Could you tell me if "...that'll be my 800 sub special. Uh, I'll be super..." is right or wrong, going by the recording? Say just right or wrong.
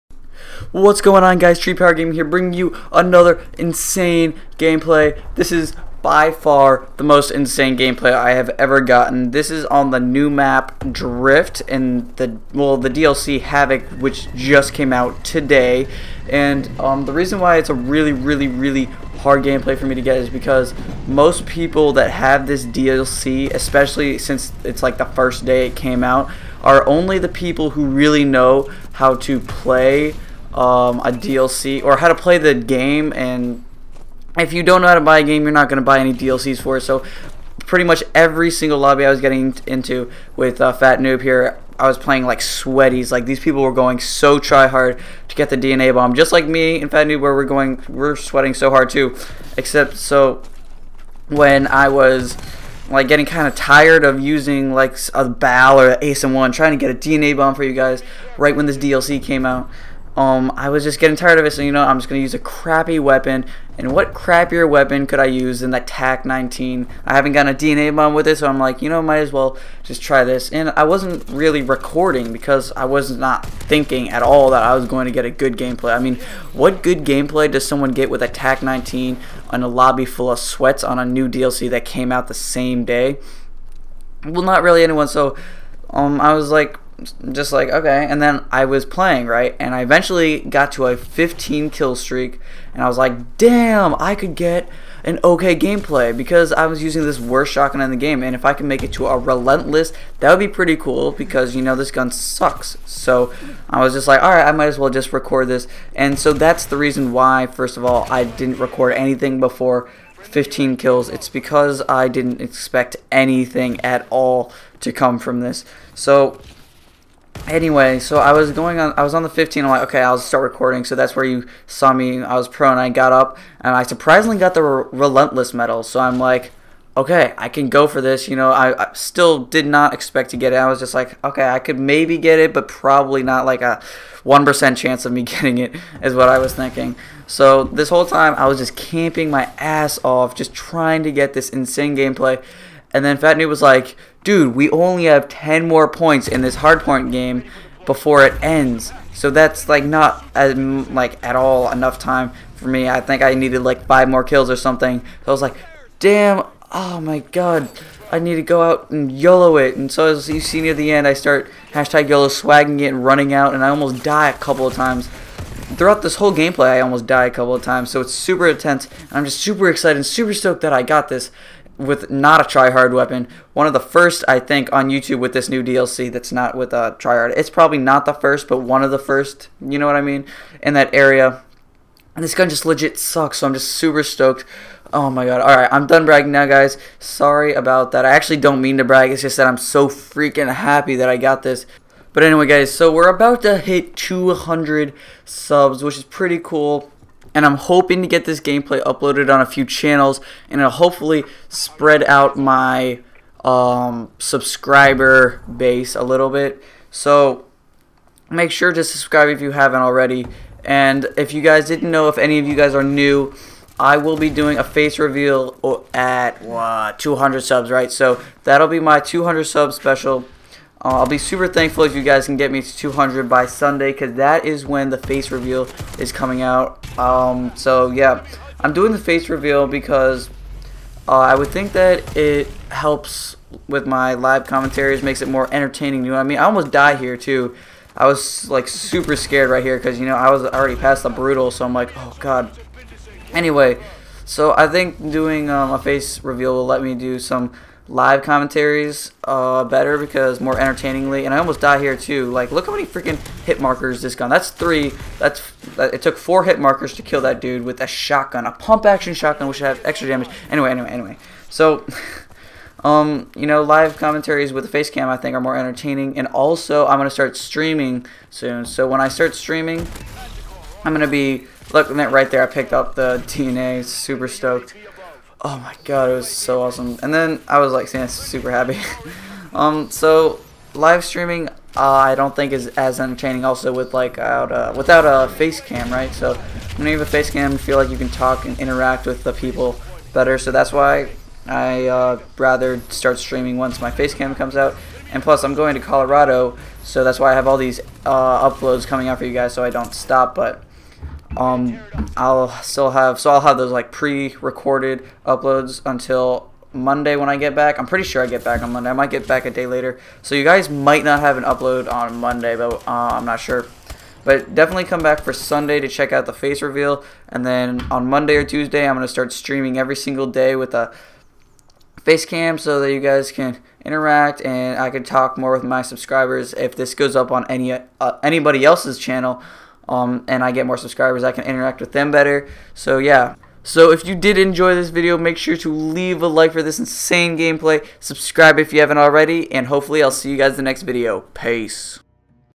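wrong.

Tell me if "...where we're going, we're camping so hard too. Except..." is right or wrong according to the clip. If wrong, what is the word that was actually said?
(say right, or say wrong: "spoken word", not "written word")
wrong: "sweating", not "camping".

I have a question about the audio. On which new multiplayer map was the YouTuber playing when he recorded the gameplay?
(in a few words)
Drift.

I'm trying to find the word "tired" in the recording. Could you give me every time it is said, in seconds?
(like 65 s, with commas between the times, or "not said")
53 s, 61 s.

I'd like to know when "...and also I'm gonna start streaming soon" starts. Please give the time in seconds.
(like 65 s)
266 s.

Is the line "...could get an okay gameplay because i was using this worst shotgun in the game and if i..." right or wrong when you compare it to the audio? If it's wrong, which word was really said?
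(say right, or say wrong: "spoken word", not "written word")
right.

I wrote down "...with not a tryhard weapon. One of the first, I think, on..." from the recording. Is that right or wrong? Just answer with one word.
right.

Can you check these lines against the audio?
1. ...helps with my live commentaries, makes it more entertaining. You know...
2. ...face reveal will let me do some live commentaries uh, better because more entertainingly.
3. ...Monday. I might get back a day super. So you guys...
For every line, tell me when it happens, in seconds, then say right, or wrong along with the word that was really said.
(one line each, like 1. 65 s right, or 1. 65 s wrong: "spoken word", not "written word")
1. 232 s right
2. 245 s right
3. 308 s wrong: "later", not "super".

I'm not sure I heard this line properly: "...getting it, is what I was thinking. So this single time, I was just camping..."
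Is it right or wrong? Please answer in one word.
wrong.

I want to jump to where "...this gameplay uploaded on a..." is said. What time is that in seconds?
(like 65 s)
198 s.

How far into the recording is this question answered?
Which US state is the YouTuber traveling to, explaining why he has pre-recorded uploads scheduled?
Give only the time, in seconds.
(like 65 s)
295 s.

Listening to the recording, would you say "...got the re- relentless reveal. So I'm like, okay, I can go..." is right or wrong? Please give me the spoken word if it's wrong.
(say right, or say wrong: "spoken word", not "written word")
wrong: "medal", not "reveal".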